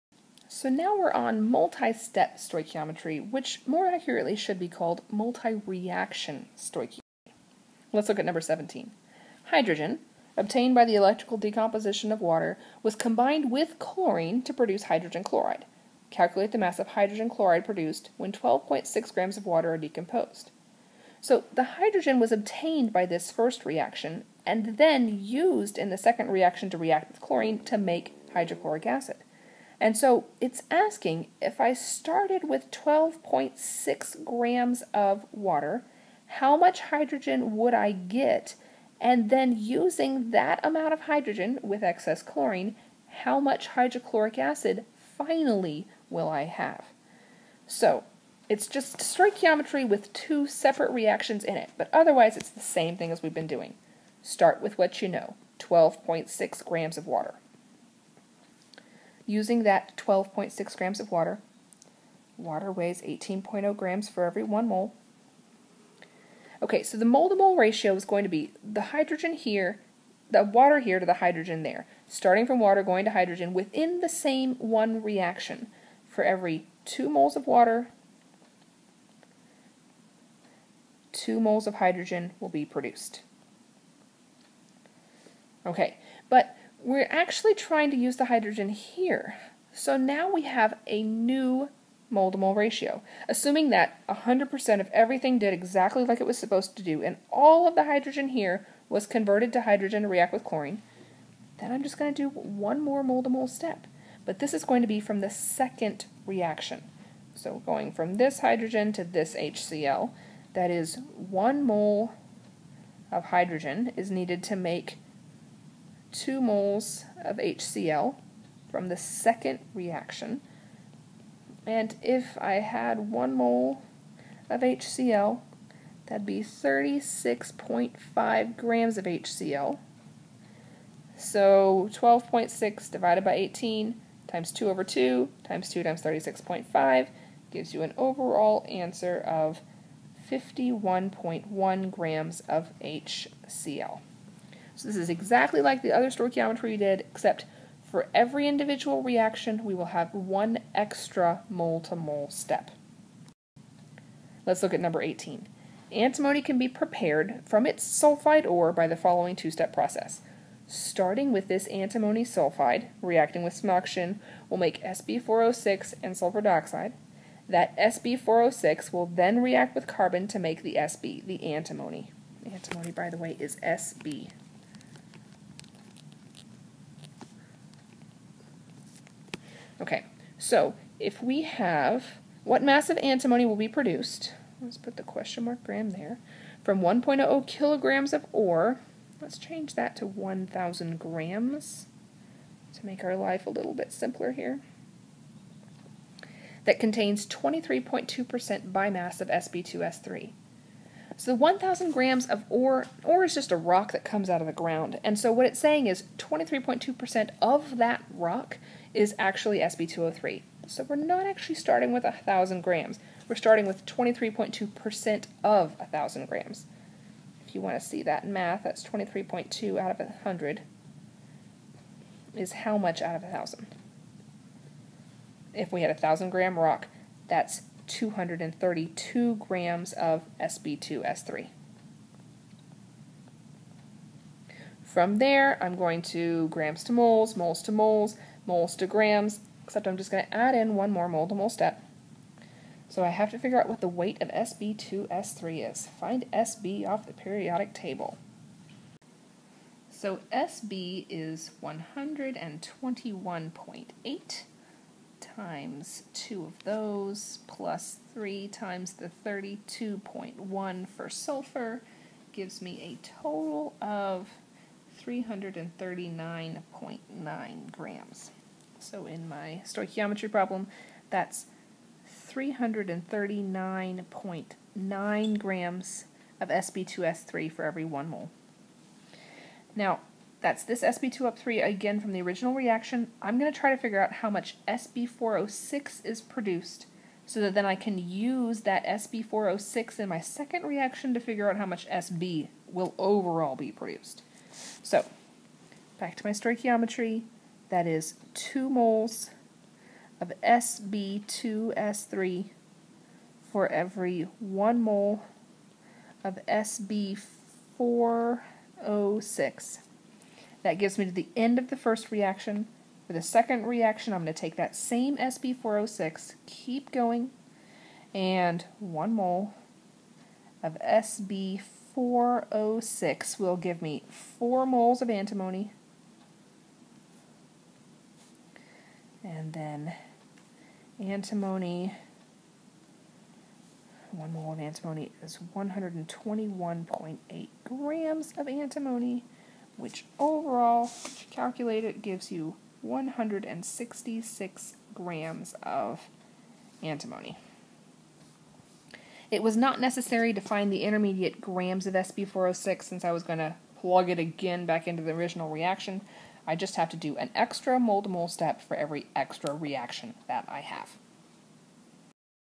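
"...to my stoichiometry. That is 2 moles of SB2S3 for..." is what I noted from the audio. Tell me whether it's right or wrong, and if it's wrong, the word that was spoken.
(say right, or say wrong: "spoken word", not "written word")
right.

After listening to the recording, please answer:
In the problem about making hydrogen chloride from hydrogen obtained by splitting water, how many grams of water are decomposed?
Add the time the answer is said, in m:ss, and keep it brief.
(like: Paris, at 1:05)
12.6 grams, at 0:18.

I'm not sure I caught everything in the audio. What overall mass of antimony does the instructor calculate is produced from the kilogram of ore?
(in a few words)
166 grams.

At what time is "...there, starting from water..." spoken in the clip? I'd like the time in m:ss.
1:11.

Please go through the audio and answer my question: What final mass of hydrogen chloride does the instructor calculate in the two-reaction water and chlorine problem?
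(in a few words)
51.1 grams.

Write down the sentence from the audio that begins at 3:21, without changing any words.
So 1,000 grams of ore, ore is just a rock that comes out of the ground.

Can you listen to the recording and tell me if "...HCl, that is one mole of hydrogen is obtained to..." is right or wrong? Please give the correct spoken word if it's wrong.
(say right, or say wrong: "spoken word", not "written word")
wrong: "needed", not "obtained".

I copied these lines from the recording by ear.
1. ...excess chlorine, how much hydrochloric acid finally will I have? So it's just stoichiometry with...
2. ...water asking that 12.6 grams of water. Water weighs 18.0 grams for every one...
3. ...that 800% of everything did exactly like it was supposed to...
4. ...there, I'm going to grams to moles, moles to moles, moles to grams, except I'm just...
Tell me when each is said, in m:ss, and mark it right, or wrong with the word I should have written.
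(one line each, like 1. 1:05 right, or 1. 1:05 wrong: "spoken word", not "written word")
1. 0:41 right
2. 0:57 wrong: "using", not "asking"
3. 1:33 wrong: "100", not "800"
4. 3:55 right.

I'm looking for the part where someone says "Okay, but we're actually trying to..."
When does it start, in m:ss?
1:25.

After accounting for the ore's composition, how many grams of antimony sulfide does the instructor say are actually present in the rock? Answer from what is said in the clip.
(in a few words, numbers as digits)
232 grams.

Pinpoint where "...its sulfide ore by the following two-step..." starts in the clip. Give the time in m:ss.
2:37.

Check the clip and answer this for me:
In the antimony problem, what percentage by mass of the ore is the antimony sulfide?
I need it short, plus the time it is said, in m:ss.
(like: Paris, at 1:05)
23.2%, at 3:17.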